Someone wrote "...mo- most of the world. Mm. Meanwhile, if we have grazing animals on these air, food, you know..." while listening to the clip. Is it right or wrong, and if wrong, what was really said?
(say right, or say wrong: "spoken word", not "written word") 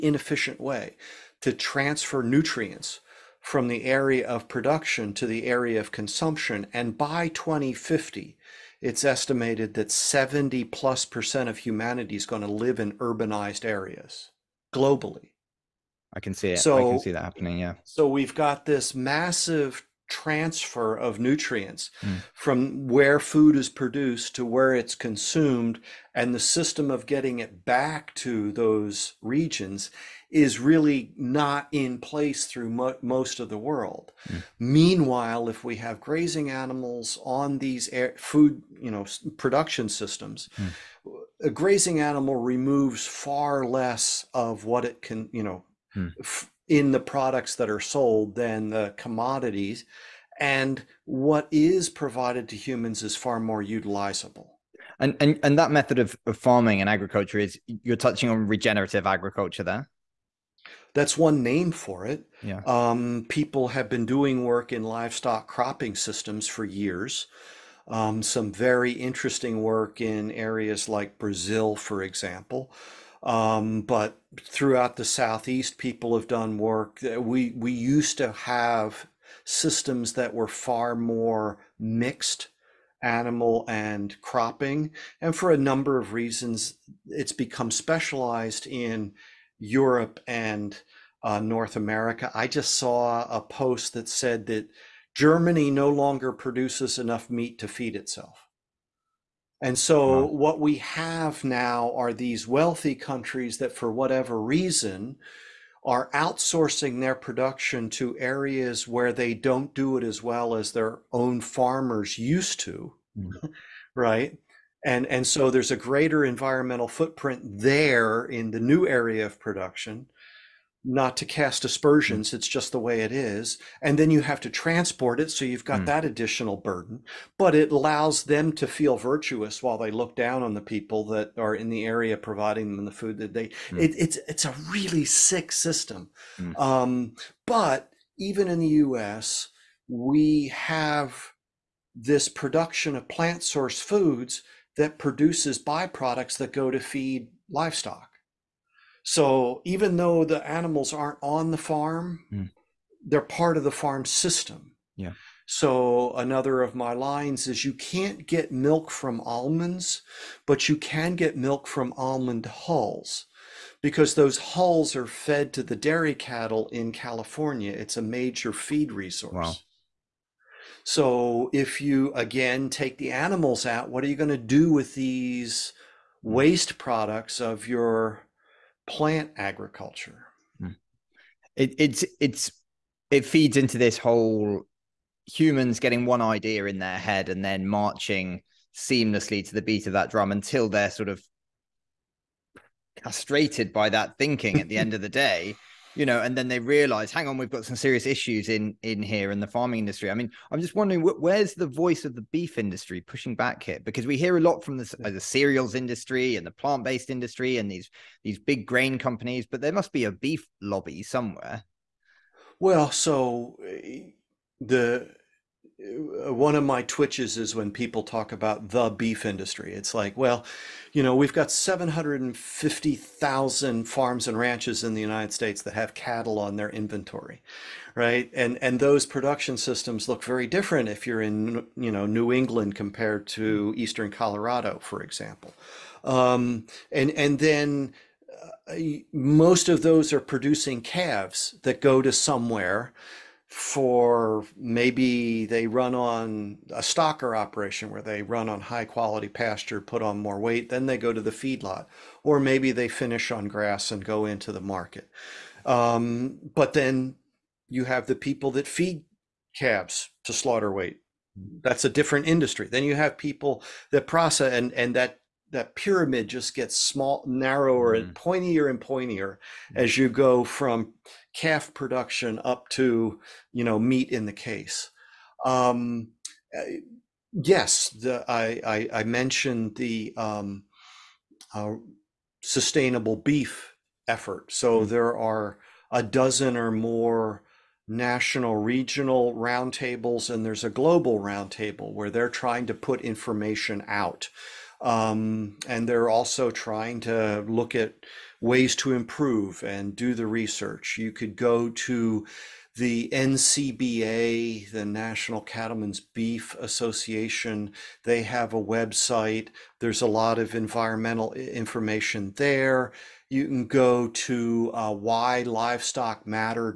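right.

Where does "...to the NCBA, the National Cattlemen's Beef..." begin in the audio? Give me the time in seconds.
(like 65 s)
301 s.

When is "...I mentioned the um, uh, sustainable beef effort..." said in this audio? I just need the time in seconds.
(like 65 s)
278 s.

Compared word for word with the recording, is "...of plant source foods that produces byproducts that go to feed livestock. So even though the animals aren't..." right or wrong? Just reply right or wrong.
right.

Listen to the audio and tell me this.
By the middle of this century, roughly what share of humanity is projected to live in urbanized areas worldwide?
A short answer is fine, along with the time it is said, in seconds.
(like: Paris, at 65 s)
70 plus percent, at 9 s.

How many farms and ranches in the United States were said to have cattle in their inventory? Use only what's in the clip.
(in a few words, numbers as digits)
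750,000.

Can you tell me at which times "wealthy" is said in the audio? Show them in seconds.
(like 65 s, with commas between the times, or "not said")
102 s.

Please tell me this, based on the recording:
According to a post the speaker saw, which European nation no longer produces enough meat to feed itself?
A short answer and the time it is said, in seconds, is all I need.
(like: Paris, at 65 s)
Germany, at 95 s.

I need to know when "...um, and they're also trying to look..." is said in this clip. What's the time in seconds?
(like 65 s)
294 s.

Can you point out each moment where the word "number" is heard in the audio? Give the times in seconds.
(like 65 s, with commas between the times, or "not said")
85 s.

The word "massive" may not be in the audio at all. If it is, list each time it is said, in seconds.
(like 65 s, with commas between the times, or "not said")
18 s.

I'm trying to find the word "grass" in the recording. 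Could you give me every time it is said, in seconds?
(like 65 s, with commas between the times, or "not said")
253 s.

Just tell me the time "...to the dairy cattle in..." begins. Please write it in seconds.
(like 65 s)
165 s.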